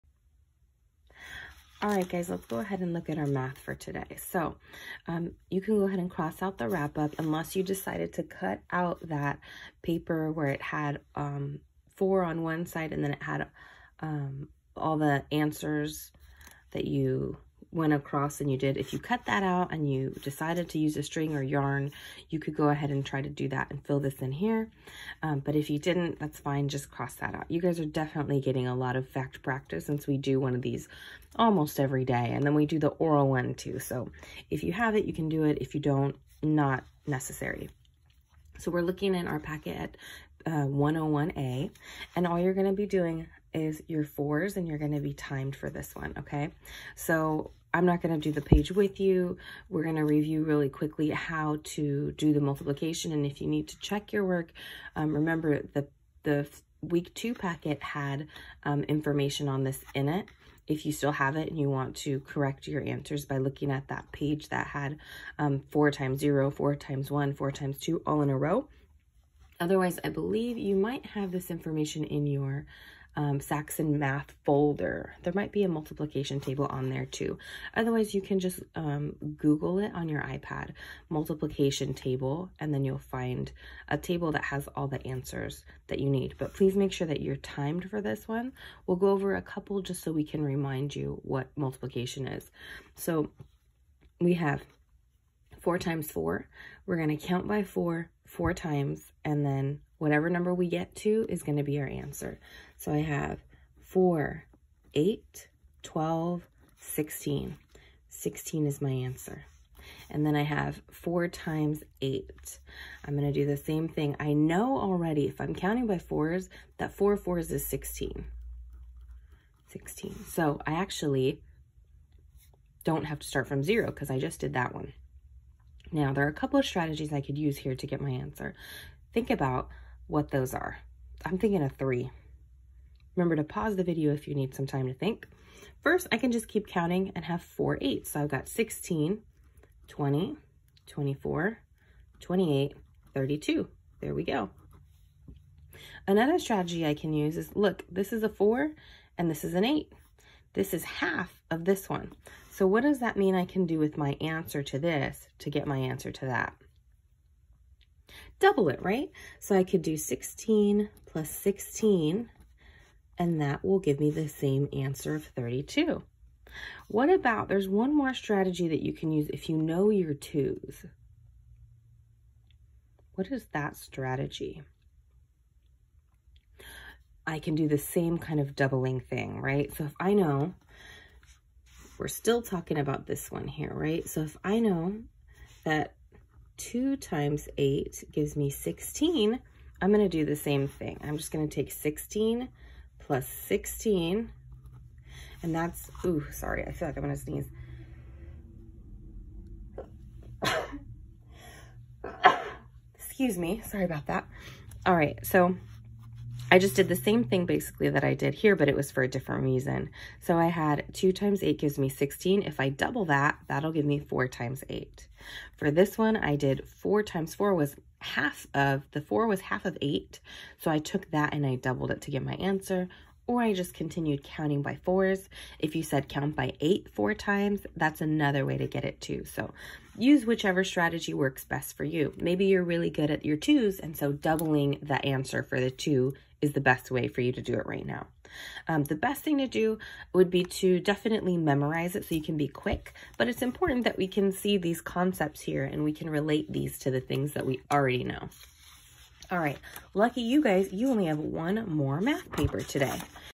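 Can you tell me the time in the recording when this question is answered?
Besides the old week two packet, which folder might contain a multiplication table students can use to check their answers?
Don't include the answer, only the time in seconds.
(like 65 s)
73 s.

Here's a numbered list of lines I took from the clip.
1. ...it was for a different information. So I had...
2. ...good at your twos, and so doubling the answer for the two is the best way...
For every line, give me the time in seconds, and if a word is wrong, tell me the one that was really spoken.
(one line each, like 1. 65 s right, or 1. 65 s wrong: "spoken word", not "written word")
1. 208 s wrong: "reason", not "information"
2. 232 s right.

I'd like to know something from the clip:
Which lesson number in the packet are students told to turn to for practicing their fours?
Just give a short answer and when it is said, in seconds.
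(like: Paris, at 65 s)
101A, at 40 s.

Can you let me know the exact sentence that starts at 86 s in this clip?
But please make sure that you're timed for this one.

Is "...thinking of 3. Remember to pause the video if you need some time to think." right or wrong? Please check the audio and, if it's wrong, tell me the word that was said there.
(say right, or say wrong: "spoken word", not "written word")
right.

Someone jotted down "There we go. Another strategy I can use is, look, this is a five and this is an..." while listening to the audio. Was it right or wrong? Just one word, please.
wrong.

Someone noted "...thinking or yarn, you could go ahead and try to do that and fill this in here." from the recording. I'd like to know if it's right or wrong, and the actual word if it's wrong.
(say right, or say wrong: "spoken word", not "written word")
wrong: "string", not "thinking".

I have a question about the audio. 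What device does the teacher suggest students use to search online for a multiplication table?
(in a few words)
iPad.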